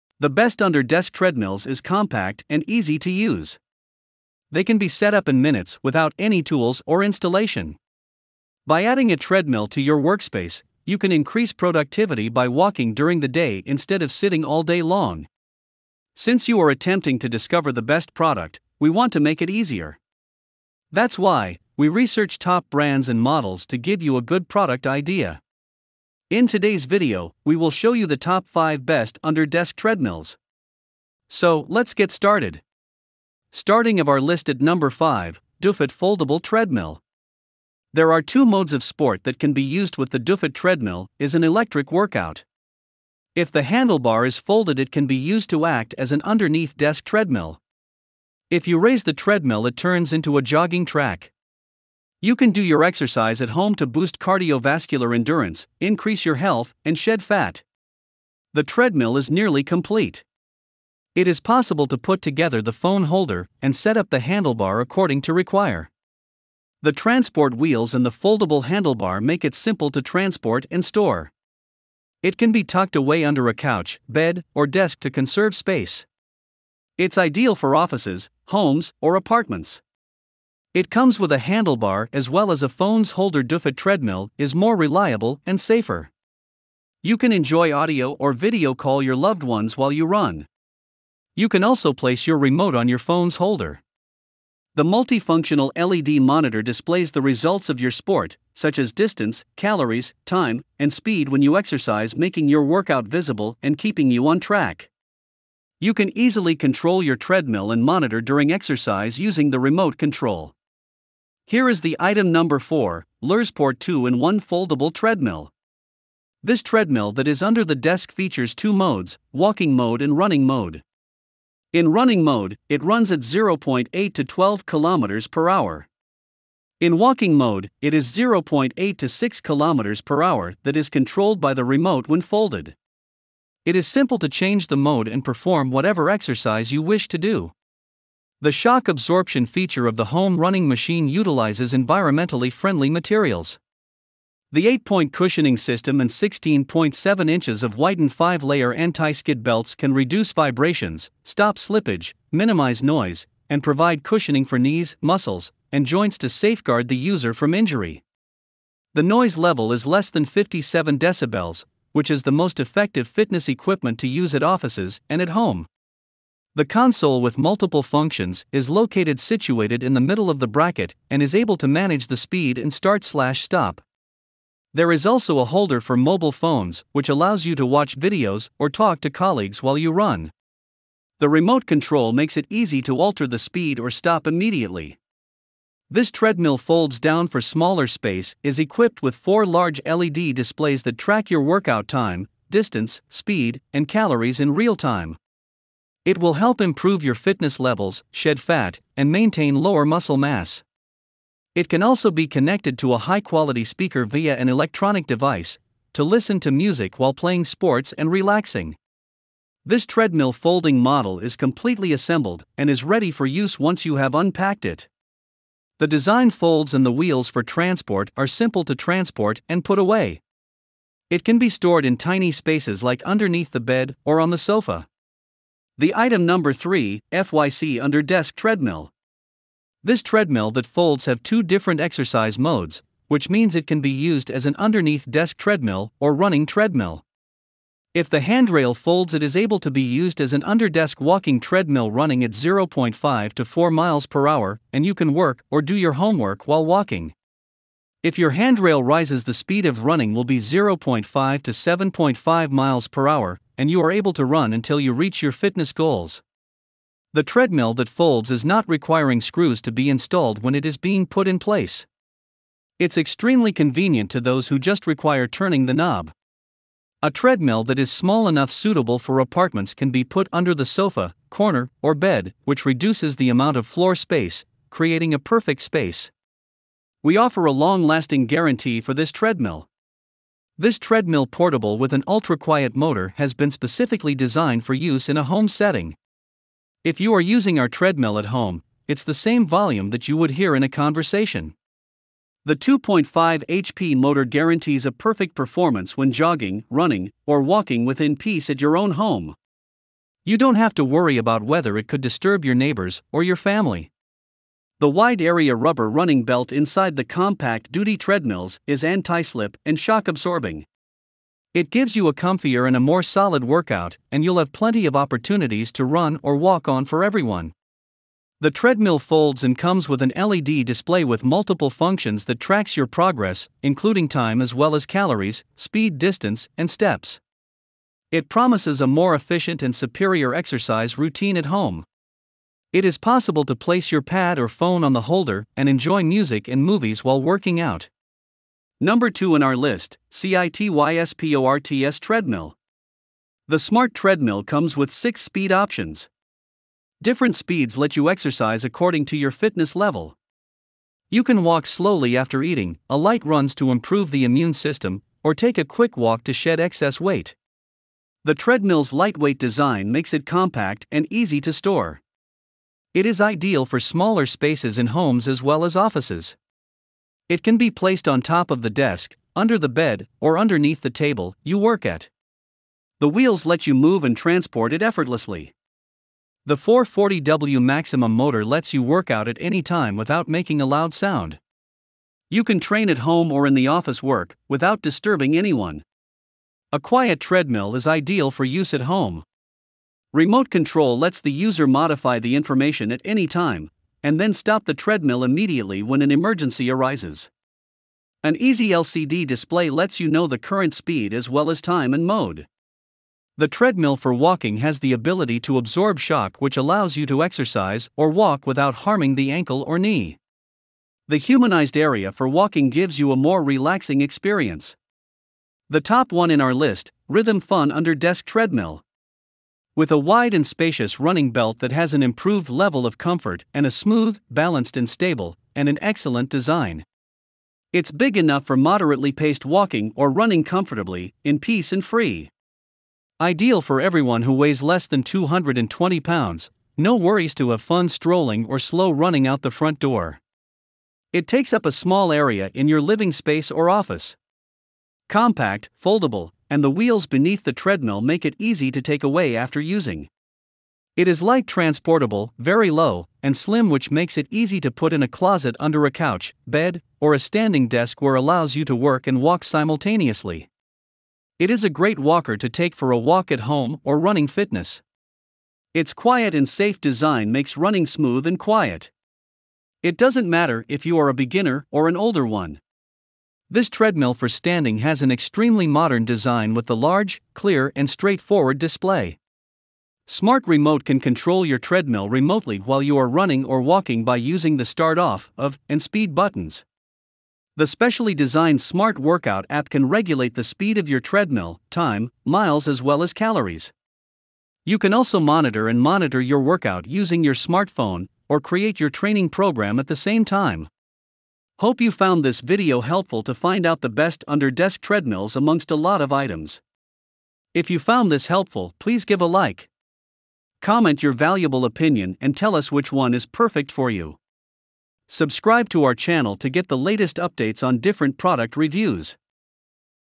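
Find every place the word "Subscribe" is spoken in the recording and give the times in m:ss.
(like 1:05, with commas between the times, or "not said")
8:35.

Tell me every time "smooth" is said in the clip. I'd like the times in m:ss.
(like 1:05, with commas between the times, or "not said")
7:03, 7:47.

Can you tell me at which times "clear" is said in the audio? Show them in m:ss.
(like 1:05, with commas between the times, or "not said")
7:57.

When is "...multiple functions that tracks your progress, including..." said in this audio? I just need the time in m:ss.
5:21.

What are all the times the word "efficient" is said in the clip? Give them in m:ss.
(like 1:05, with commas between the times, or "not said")
5:29.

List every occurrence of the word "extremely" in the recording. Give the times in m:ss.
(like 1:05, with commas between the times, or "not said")
4:22, 7:55.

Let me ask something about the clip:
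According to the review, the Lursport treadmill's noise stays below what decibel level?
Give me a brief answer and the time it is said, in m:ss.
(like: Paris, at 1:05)
57, at 2:40.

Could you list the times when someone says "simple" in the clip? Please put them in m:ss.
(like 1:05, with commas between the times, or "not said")
1:09, 2:13, 3:38.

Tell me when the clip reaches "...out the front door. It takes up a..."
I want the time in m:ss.
7:19.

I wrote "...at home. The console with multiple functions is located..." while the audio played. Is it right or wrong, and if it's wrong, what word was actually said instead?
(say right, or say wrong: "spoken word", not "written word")
right.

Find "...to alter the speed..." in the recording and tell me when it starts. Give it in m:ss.
3:02.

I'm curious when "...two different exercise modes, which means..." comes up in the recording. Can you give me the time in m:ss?
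3:51.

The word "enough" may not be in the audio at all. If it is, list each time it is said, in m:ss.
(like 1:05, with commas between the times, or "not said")
4:28, 7:08.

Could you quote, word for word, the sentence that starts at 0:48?
If you raise the treadmill it turns into a jogging track.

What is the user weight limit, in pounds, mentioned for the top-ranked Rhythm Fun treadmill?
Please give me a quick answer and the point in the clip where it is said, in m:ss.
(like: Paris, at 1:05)
220, at 7:15.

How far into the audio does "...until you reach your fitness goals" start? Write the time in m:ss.
4:14.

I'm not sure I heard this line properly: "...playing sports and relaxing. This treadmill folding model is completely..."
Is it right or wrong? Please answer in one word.
right.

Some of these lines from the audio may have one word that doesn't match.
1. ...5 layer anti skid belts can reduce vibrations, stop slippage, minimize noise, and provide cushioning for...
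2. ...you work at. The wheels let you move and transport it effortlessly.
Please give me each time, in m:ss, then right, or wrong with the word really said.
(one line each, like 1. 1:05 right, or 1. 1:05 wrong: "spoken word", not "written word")
1. 2:28 right
2. 6:11 right.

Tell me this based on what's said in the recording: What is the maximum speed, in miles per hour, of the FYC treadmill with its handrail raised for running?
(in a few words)
7.5.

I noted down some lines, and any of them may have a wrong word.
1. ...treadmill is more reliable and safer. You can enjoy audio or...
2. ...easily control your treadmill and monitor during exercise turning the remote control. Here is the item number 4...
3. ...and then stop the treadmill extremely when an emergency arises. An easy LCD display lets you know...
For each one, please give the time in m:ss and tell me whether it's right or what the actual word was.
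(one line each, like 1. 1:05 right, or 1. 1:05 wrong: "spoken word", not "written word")
1. 1:23 right
2. 1:46 wrong: "using", not "turning"
3. 6:34 wrong: "immediately", not "extremely".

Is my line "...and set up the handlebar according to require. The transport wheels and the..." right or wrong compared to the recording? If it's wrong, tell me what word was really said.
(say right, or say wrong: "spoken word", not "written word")
right.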